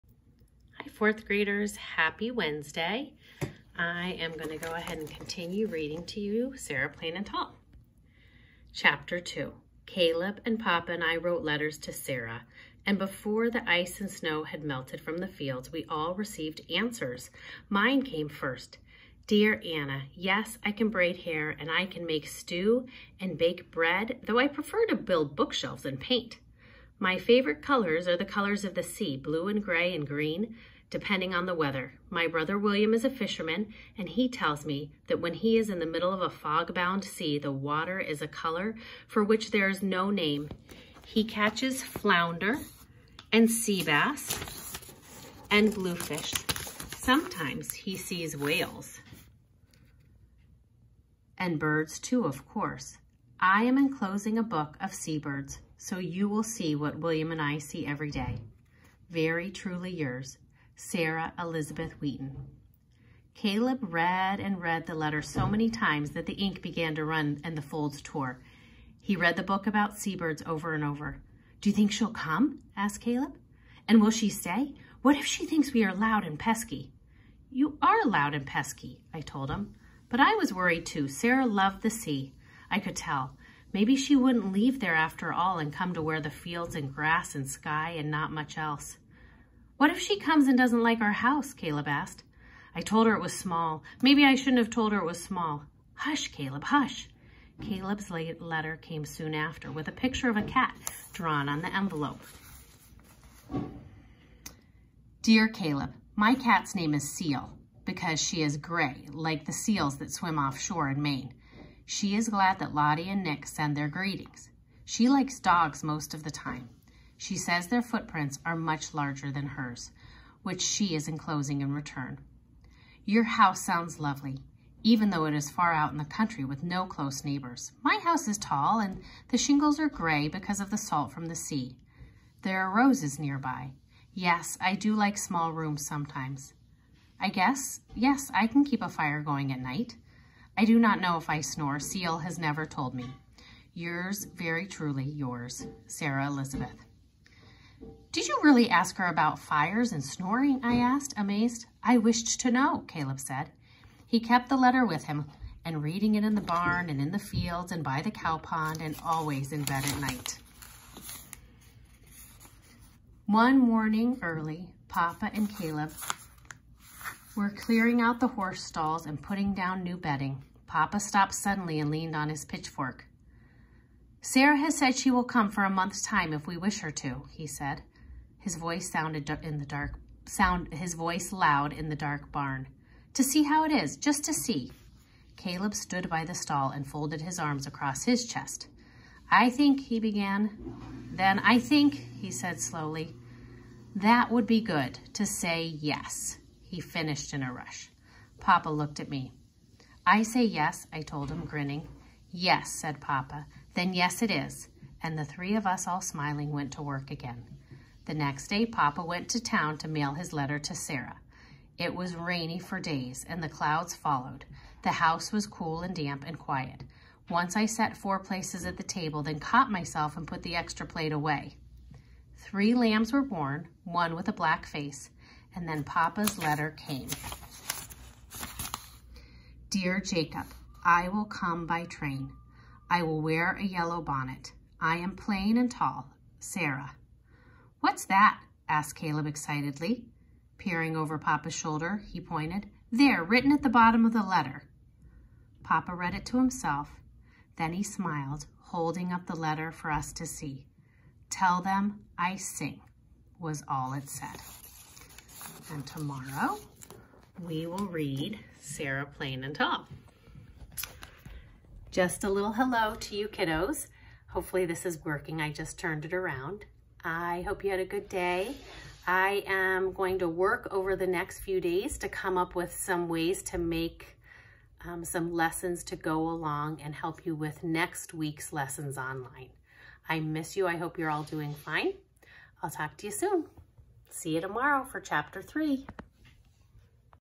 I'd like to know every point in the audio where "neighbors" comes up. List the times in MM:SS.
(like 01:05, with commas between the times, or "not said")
02:07.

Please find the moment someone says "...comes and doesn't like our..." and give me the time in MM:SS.
01:30.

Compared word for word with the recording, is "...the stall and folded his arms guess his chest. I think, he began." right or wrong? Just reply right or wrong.
wrong.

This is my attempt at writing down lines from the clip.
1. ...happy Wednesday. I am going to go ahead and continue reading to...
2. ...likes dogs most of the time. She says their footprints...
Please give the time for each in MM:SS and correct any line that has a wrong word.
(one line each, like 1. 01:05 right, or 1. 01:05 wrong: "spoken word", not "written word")
1. 00:01 right
2. 01:55 right.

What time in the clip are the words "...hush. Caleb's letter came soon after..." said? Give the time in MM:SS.
01:36.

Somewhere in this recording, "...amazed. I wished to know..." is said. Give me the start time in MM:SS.
02:31.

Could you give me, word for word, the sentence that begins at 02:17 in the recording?
I guess, yes, I can keep a fire going at night.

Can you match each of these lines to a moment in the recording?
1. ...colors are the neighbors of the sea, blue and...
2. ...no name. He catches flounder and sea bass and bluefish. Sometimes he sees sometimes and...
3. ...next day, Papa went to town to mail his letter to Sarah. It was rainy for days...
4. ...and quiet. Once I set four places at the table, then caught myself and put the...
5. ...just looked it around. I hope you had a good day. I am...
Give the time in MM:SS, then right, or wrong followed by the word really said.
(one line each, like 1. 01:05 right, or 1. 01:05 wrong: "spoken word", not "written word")
1. 00:27 wrong: "colors", not "neighbors"
2. 00:39 wrong: "whales", not "sometimes"
3. 03:28 right
4. 03:36 right
5. 04:25 wrong: "turned", not "looked".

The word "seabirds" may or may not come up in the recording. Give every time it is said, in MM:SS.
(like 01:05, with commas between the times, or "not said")
00:54, 01:09.